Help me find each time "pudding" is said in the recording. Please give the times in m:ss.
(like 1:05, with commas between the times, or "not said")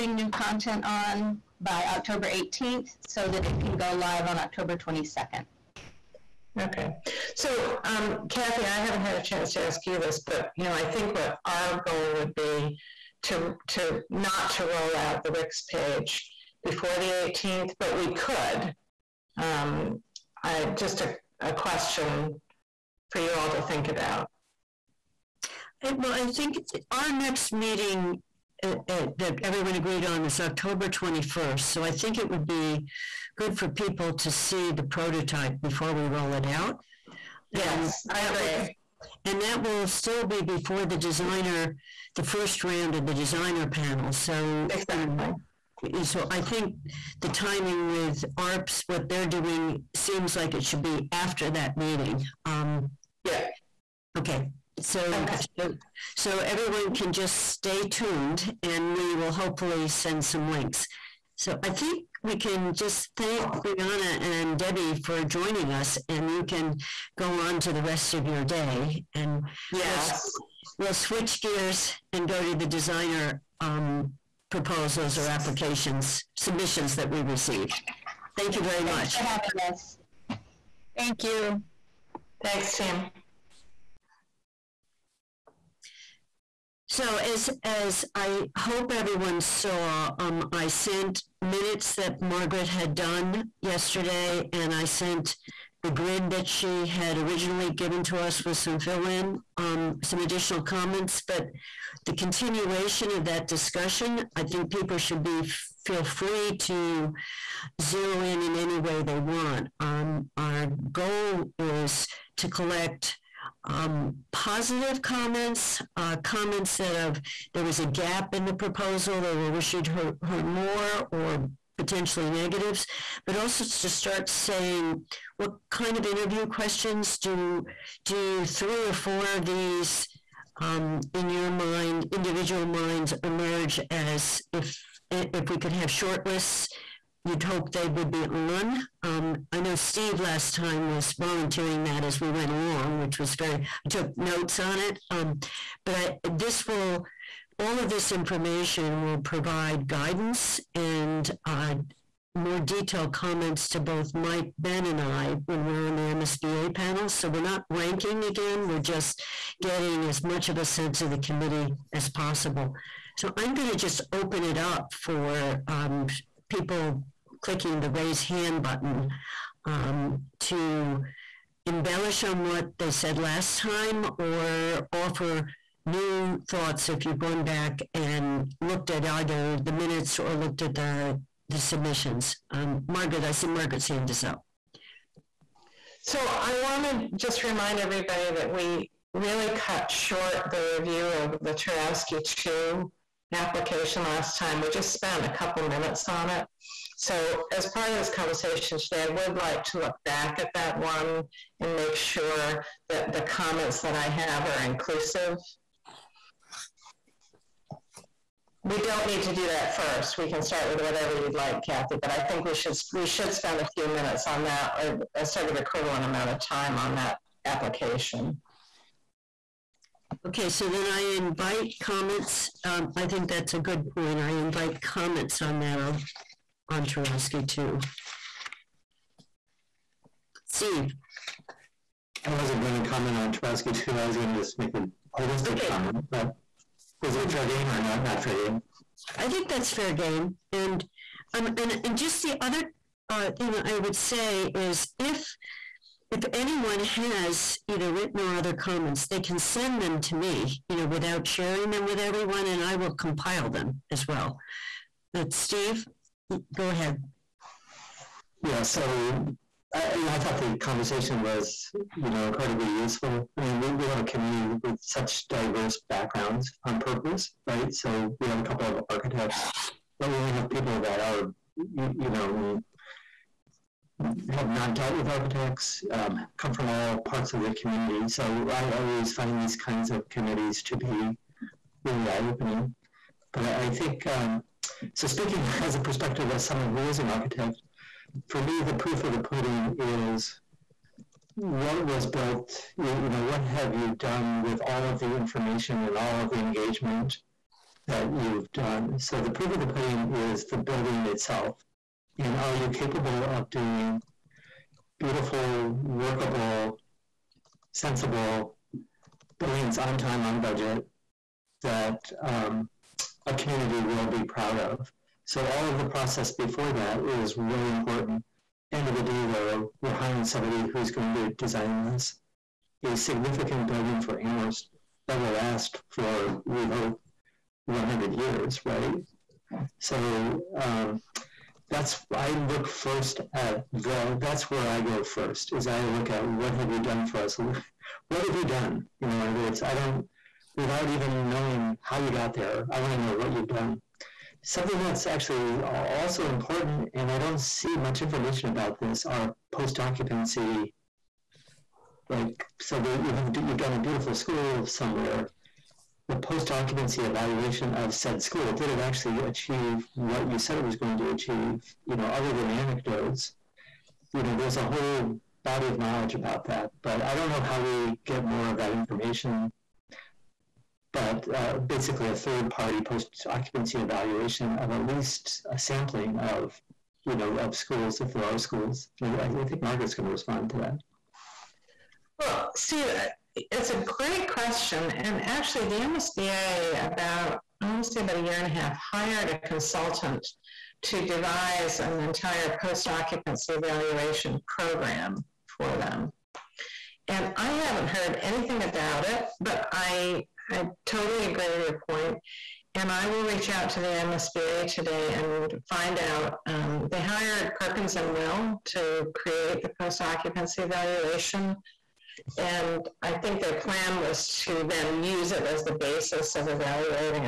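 4:49, 4:59.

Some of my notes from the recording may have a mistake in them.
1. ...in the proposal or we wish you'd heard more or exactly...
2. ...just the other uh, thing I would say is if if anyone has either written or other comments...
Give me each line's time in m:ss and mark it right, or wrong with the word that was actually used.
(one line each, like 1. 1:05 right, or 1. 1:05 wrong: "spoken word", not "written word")
1. 1:58 wrong: "potentially", not "exactly"
2. 4:01 right.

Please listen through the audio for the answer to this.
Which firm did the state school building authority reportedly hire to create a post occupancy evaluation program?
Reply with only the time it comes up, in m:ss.
6:47.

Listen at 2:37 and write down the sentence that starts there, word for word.
So we're not ranking again, we're just getting as much of a sense of the committee as possible.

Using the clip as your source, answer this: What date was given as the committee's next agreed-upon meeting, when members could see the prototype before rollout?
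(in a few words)
October 21st.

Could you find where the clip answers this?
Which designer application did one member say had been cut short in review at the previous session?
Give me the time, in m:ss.
3:11.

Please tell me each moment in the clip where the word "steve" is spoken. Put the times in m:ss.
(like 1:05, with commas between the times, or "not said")
2:19, 3:50, 4:15, 6:22.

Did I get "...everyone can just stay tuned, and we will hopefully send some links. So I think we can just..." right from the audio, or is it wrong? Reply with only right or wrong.
right.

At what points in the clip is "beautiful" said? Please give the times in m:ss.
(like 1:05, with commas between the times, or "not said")
5:04, 5:53.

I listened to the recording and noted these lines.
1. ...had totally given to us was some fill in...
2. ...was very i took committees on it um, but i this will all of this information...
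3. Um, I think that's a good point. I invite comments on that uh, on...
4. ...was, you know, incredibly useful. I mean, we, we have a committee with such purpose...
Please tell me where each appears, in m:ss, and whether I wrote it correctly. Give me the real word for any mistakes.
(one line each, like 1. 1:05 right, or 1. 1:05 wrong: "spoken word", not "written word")
1. 1:36 wrong: "originally", not "totally"
2. 2:23 wrong: "notes", not "committees"
3. 3:42 right
4. 4:21 wrong: "diverse", not "purpose".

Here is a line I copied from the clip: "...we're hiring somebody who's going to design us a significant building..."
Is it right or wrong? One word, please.
right.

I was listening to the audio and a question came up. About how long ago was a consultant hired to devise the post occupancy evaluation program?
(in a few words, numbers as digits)
a year and a half.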